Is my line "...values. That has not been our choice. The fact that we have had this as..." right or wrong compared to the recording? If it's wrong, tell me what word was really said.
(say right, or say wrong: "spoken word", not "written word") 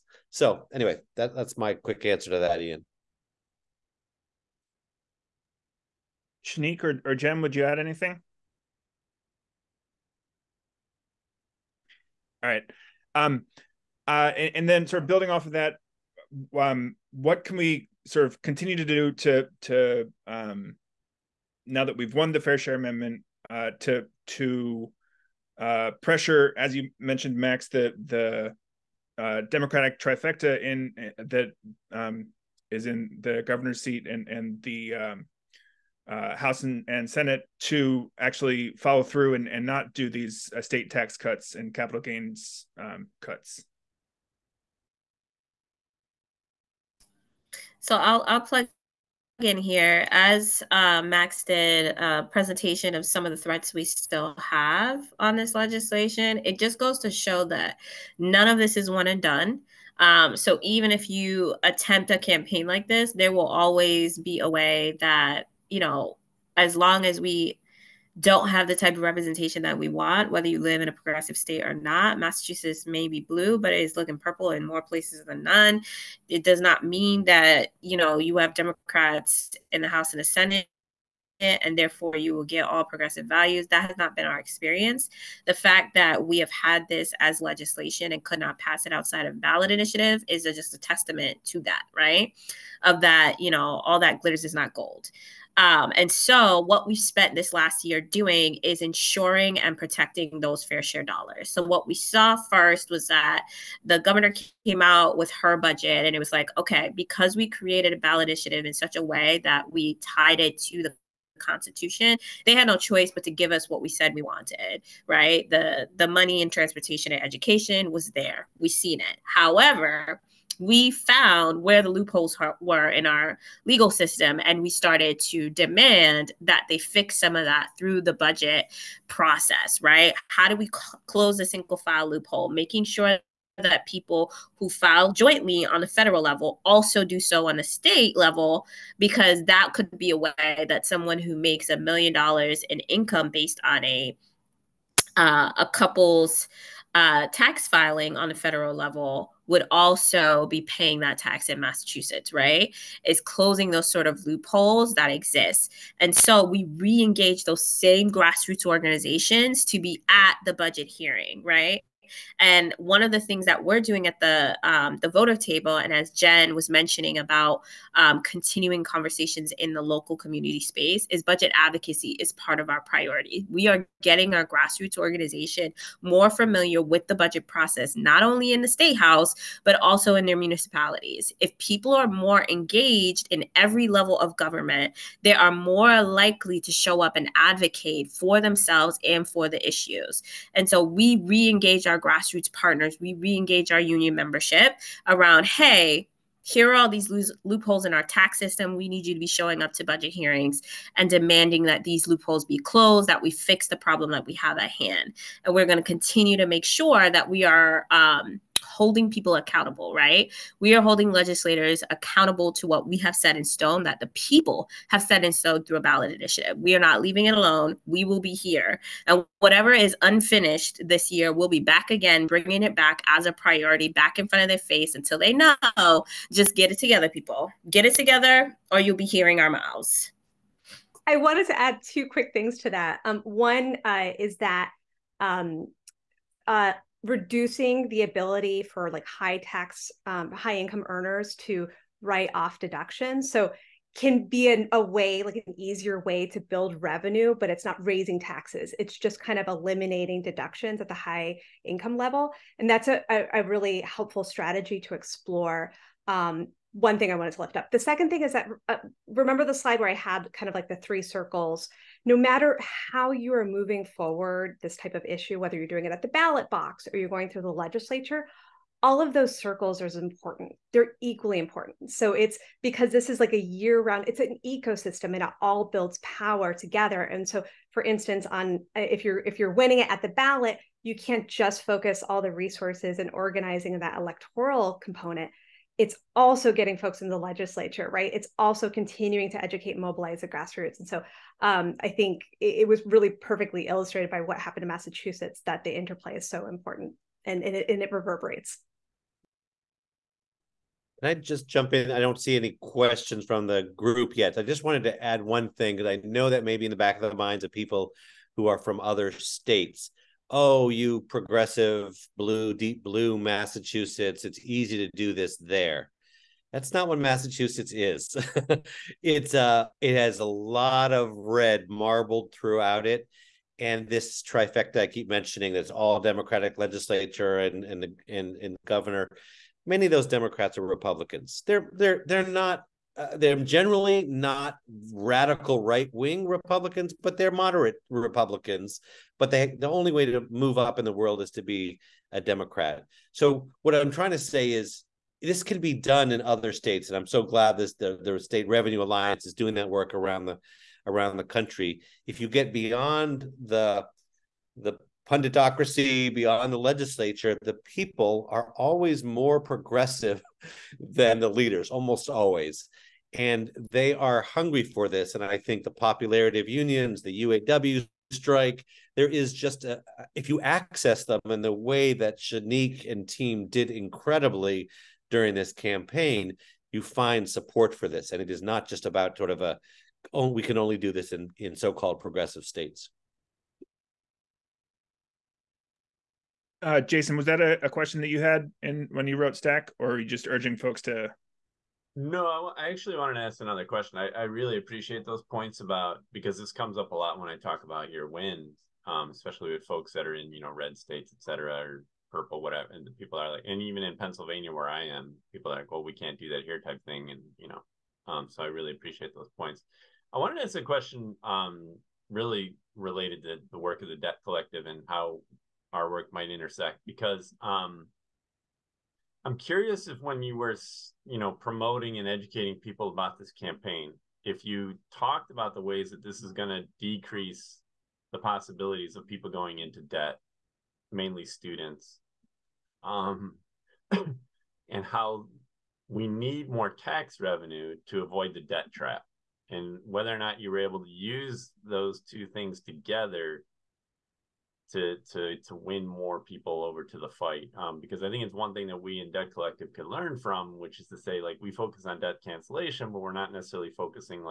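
wrong: "experience", not "choice".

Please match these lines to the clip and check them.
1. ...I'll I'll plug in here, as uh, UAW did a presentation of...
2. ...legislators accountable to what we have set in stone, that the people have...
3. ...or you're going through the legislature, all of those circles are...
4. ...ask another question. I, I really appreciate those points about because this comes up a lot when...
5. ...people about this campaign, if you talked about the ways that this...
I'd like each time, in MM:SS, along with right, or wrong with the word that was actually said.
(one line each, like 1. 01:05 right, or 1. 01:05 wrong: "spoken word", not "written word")
1. 00:47 wrong: "Max", not "UAW"
2. 03:31 right
3. 04:26 right
4. 06:33 right
5. 07:02 right.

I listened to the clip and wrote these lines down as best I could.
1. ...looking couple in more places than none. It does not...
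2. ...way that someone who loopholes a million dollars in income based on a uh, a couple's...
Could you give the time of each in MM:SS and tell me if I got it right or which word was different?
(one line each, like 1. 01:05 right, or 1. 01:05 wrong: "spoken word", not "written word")
1. 01:13 wrong: "purple", not "couple"
2. 02:20 wrong: "makes", not "loopholes".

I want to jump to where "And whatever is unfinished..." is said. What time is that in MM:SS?
03:39.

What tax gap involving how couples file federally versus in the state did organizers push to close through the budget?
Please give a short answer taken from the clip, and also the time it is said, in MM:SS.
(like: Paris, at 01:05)
single file loophole, at 02:11.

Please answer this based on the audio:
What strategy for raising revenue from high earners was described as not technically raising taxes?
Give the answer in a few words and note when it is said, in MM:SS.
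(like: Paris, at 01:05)
eliminating deductions, at 04:09.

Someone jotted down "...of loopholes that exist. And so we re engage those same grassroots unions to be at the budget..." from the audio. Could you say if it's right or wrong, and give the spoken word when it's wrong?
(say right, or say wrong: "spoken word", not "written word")
wrong: "organizations", not "unions".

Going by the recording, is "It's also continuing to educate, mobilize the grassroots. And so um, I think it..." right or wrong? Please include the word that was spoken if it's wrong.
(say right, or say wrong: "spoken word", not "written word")
right.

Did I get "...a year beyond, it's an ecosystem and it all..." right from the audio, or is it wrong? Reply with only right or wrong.
wrong.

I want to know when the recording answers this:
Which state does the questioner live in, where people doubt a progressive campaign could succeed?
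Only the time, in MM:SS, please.
06:43.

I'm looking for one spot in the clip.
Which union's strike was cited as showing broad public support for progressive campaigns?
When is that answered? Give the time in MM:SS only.
06:07.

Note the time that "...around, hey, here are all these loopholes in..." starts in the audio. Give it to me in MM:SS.
03:15.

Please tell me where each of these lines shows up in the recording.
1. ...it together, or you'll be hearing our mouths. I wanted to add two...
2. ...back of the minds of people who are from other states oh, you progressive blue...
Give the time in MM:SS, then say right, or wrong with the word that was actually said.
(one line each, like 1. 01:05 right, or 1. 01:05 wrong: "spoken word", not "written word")
1. 03:47 right
2. 05:06 right.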